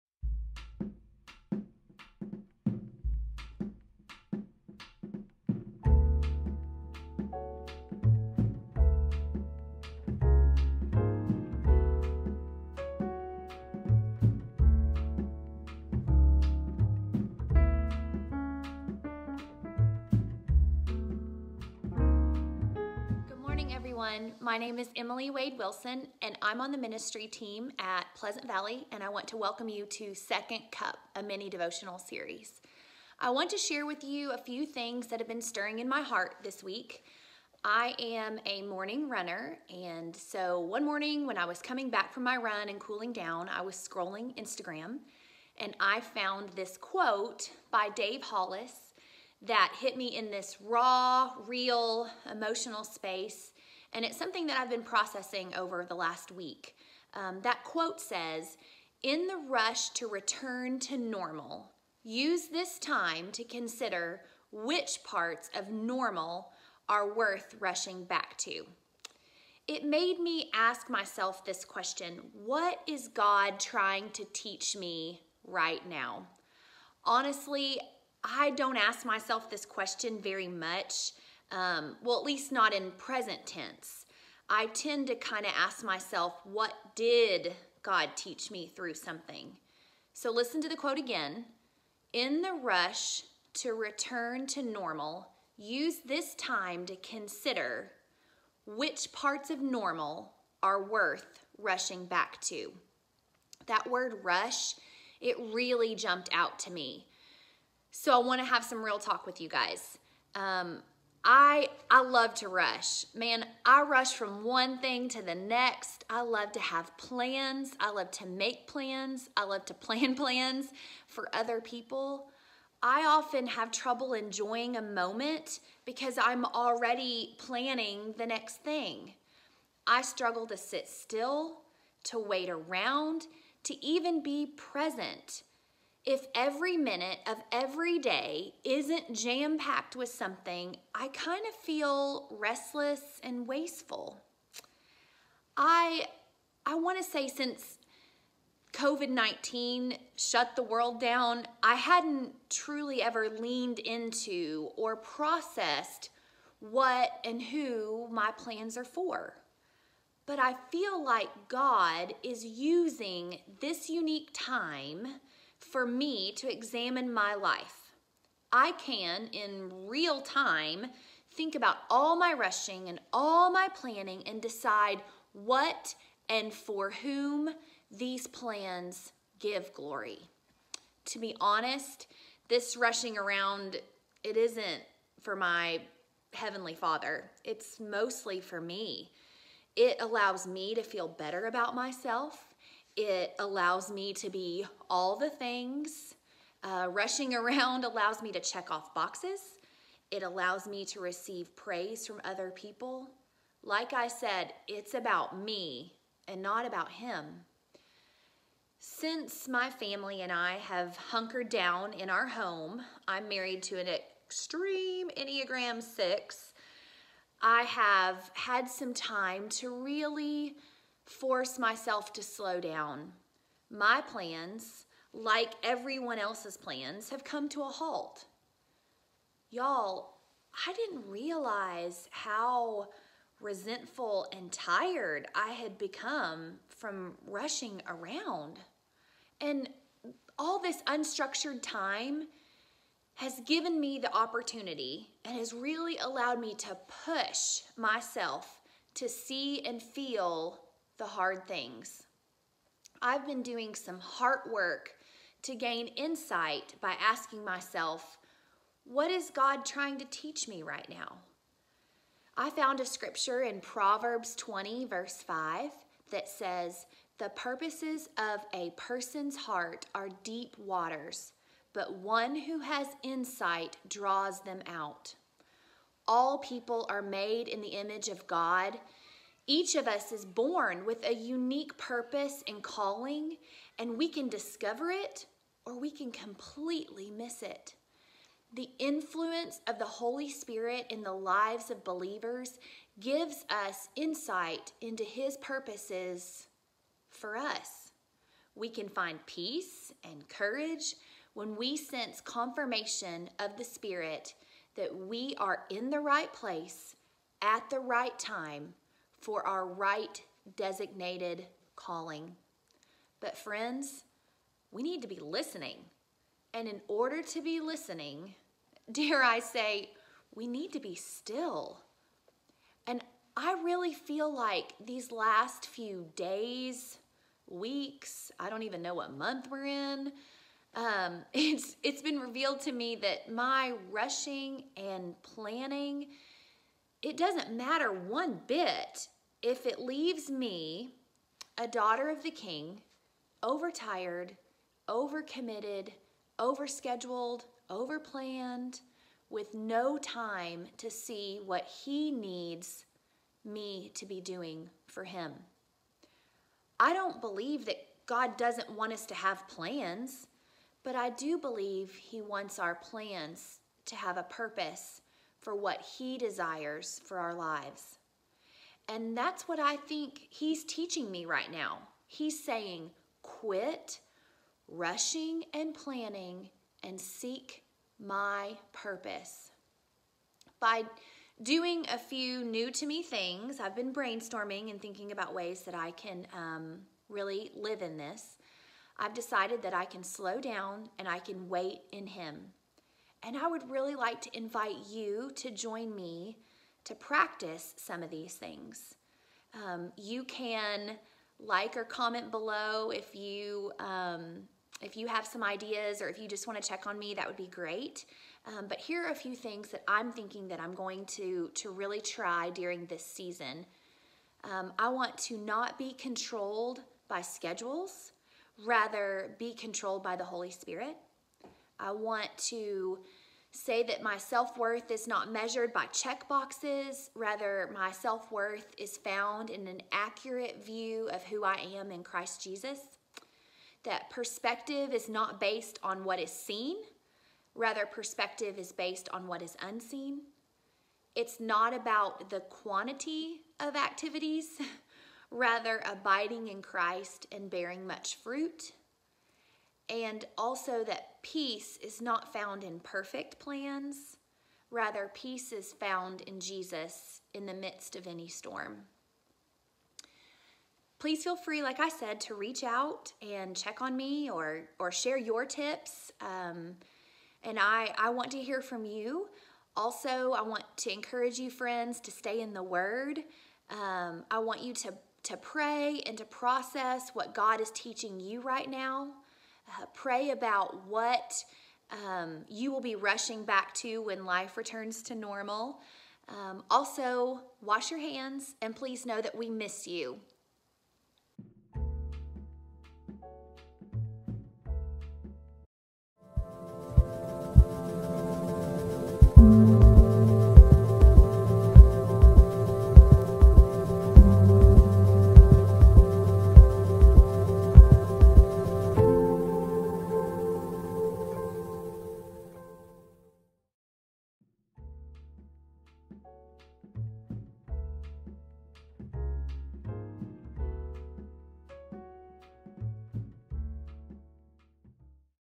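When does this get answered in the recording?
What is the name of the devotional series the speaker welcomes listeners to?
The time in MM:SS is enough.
00:30.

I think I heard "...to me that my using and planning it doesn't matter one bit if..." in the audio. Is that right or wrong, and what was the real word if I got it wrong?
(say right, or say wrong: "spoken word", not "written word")
wrong: "rushing", not "using".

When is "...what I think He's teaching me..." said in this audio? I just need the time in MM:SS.
06:09.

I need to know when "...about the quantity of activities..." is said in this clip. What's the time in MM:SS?
07:21.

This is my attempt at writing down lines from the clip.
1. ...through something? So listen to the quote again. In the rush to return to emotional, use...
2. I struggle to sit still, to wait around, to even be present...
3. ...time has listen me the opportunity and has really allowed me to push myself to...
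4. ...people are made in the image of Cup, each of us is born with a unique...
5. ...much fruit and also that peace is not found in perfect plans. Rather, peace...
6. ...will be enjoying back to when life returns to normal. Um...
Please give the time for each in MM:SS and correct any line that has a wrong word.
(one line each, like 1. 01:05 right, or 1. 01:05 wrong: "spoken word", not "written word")
1. 01:28 wrong: "normal", not "emotional"
2. 02:09 right
3. 04:01 wrong: "given", not "listen"
4. 04:36 wrong: "God", not "Cup"
5. 07:27 right
6. 08:02 wrong: "rushing", not "enjoying".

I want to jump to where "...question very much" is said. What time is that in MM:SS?
01:19.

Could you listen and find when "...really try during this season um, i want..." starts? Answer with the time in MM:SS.
06:51.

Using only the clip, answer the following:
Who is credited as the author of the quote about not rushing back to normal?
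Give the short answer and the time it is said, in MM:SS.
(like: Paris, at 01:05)
Dave Hollis, at 00:47.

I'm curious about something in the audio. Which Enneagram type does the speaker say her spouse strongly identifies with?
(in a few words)
6.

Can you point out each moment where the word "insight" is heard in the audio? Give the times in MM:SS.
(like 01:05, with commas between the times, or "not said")
04:15, 04:33, 04:53.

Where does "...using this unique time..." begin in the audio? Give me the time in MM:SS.
02:42.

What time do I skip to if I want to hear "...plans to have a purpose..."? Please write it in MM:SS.
06:02.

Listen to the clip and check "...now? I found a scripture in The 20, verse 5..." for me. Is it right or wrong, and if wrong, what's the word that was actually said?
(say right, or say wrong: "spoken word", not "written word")
wrong: "Proverbs", not "The".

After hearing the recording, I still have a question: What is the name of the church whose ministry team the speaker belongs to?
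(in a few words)
Pleasant Valley.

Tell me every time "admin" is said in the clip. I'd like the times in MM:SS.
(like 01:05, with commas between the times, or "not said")
not said.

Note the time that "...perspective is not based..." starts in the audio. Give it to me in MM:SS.
07:14.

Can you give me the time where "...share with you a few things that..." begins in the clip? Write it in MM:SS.
00:33.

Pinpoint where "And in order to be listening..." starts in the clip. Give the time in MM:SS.
05:16.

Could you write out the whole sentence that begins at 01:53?
Man, I rush from one thing to the next.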